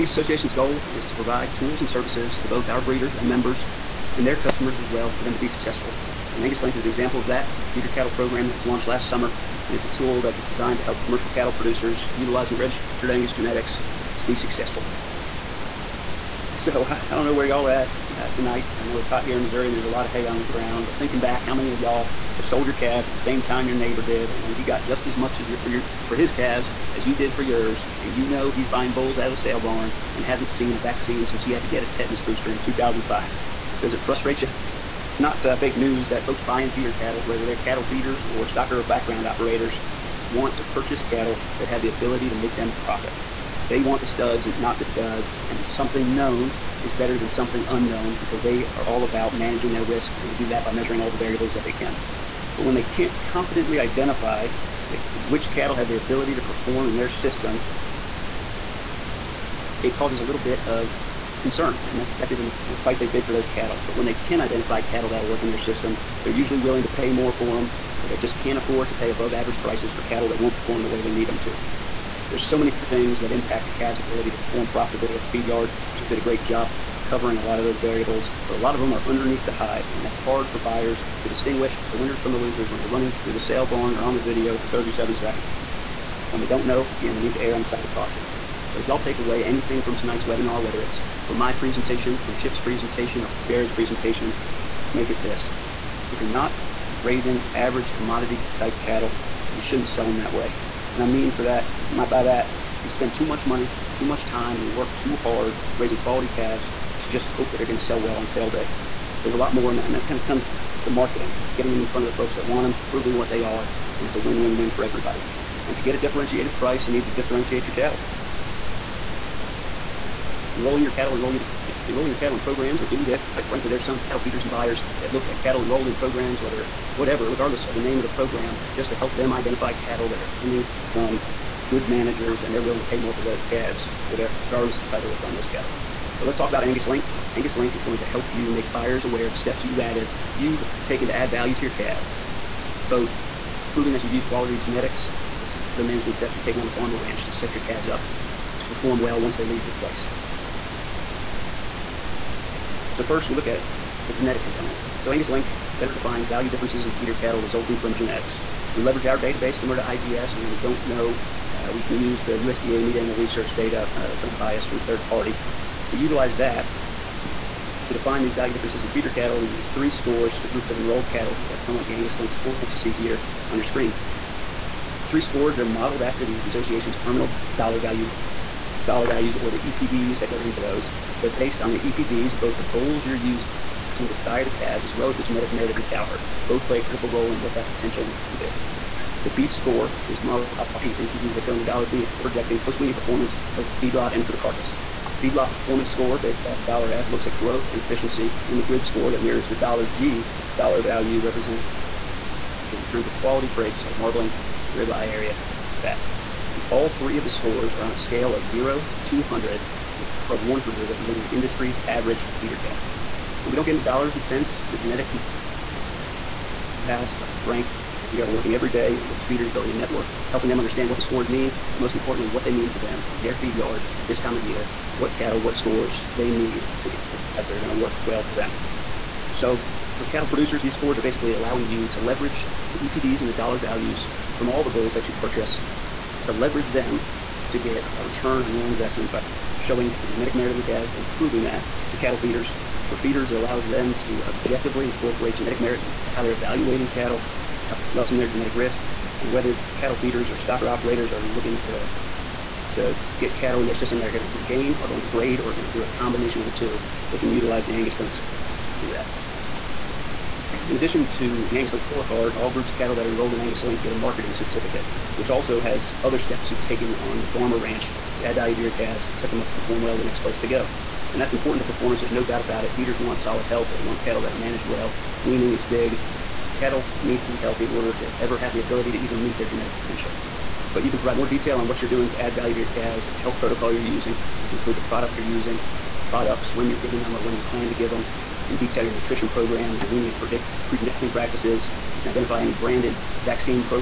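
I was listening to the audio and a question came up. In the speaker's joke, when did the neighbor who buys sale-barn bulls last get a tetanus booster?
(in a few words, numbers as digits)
2005.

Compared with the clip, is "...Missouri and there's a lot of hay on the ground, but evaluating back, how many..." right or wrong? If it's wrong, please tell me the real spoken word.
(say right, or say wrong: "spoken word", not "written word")
wrong: "thinking", not "evaluating".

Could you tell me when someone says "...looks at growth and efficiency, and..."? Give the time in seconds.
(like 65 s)
197 s.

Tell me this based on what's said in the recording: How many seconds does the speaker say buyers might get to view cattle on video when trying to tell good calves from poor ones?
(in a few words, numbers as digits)
37.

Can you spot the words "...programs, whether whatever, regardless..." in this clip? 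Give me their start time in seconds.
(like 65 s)
125 s.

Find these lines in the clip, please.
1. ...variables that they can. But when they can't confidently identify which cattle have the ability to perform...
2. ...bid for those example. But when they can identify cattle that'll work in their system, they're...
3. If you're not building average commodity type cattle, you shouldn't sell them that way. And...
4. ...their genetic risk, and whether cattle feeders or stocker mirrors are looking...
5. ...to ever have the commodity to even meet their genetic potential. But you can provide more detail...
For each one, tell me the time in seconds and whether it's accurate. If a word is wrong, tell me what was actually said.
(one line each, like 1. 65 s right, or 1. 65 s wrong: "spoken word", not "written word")
1. 51 s right
2. 63 s wrong: "cattle", not "example"
3. 96 s wrong: "raising", not "building"
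4. 248 s wrong: "operators", not "mirrors"
5. 277 s wrong: "ability", not "commodity".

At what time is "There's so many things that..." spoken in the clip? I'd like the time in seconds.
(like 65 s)
72 s.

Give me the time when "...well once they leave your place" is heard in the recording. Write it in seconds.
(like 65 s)
148 s.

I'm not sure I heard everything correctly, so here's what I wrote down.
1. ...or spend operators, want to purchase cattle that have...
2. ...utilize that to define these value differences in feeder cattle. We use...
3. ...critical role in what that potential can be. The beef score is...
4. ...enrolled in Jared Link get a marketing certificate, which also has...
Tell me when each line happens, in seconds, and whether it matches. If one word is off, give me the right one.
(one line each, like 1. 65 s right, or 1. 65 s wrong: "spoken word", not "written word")
1. 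38 s wrong: "background", not "spend"
2. 165 s right
3. 186 s right
4. 263 s wrong: "Angus", not "Jared".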